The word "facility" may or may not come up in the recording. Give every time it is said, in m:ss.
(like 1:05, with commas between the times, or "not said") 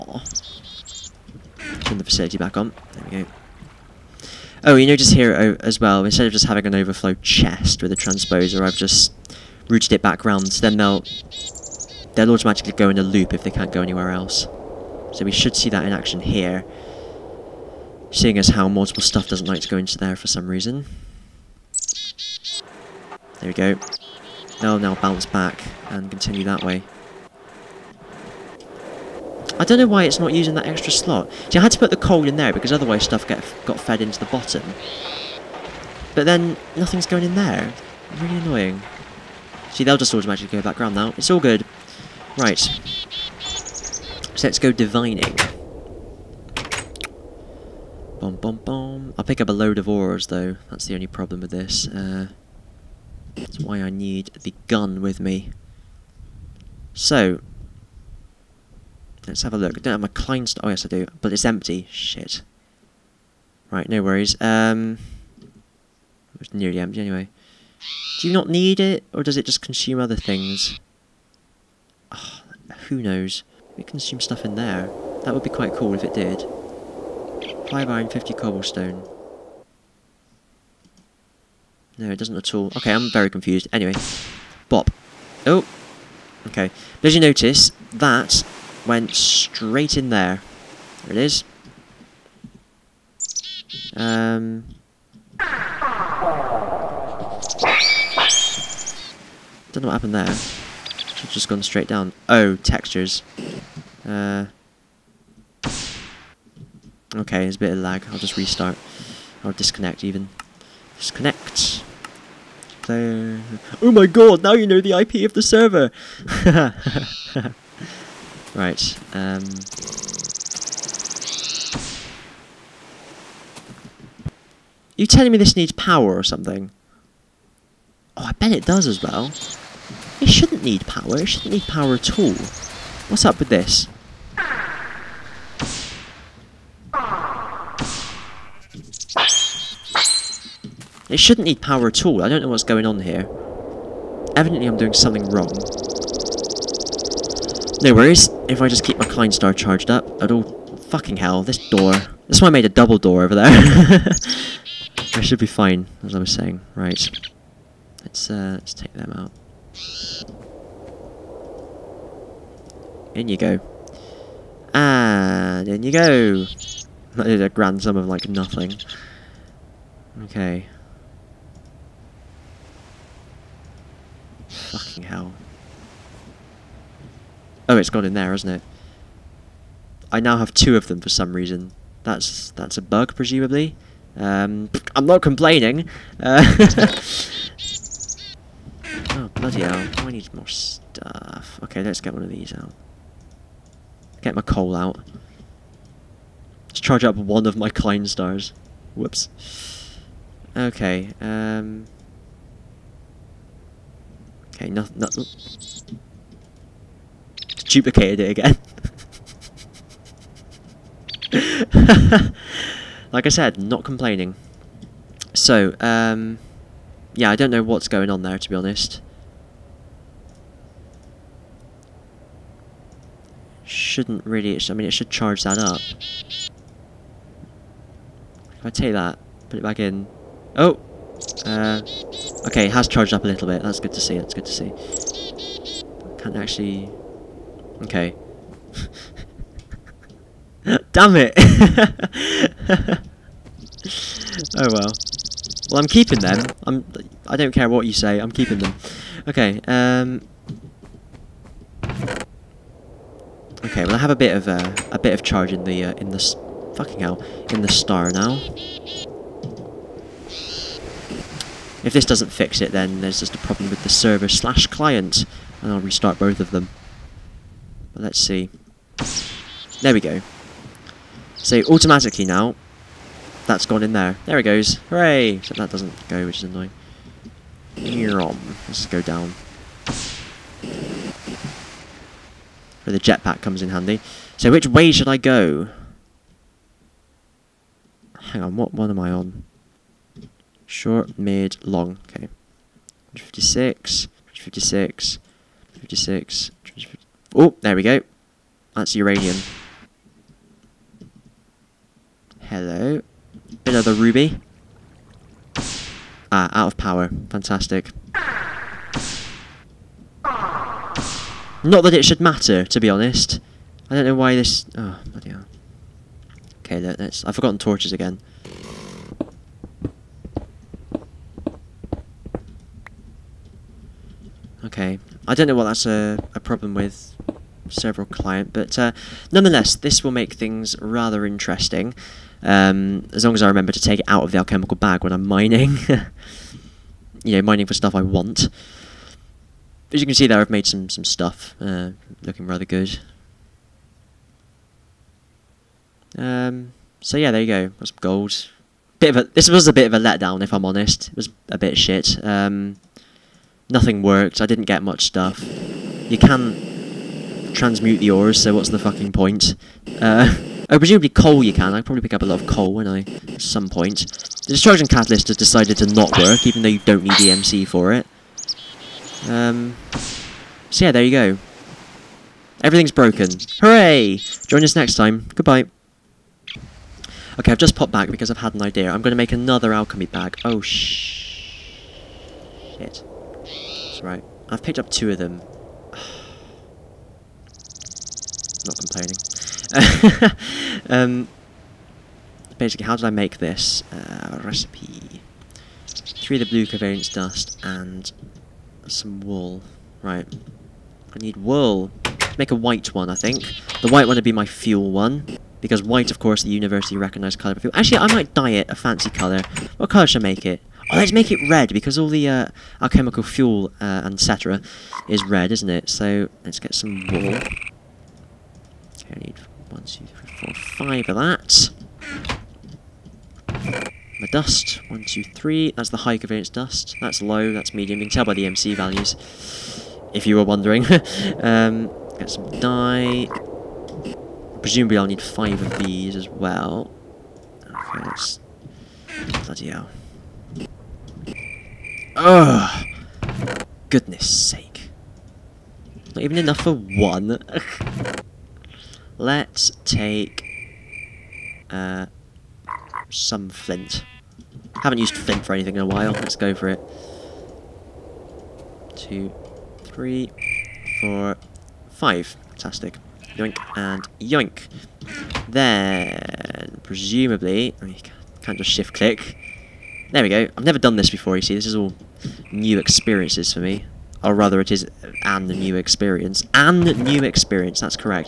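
0:02.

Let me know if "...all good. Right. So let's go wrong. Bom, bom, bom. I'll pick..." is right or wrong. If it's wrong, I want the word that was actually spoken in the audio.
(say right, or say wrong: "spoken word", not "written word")
wrong: "divining", not "wrong".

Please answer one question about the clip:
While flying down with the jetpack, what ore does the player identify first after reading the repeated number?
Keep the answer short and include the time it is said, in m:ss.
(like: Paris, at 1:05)
Uranium, at 4:58.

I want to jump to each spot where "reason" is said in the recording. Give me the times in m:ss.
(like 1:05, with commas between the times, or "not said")
0:20, 3:01.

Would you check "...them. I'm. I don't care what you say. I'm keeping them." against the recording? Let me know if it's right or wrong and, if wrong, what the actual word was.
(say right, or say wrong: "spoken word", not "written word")
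right.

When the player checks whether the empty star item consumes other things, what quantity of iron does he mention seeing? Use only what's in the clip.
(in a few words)
5.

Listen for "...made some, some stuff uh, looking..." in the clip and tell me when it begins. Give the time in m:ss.
5:40.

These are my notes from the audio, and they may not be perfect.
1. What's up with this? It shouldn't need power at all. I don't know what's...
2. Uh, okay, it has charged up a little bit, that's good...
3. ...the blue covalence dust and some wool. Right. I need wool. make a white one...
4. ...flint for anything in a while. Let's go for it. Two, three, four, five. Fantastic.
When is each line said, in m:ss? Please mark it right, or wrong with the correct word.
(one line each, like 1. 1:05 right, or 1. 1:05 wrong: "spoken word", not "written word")
1. 2:13 right
2. 3:51 right
3. 6:36 right
4. 7:35 right.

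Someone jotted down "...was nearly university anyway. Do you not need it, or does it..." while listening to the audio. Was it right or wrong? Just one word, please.
wrong.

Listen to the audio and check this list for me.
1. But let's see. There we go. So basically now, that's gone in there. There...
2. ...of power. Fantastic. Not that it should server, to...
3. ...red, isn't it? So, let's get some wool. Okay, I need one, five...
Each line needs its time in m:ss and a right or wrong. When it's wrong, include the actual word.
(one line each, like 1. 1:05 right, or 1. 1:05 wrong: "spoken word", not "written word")
1. 4:27 wrong: "automatically", not "basically"
2. 5:06 wrong: "matter", not "server"
3. 6:55 wrong: "two", not "five".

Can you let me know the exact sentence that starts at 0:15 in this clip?
So we should see that in action here.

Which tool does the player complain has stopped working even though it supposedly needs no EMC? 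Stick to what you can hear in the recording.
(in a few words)
Destruction catalyst.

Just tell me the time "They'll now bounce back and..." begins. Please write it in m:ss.
0:24.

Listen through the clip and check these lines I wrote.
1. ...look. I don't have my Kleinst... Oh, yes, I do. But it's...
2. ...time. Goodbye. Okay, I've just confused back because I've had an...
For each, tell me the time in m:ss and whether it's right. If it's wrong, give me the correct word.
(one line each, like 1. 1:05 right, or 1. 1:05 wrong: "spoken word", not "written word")
1. 0:59 right
2. 6:14 wrong: "popped", not "confused".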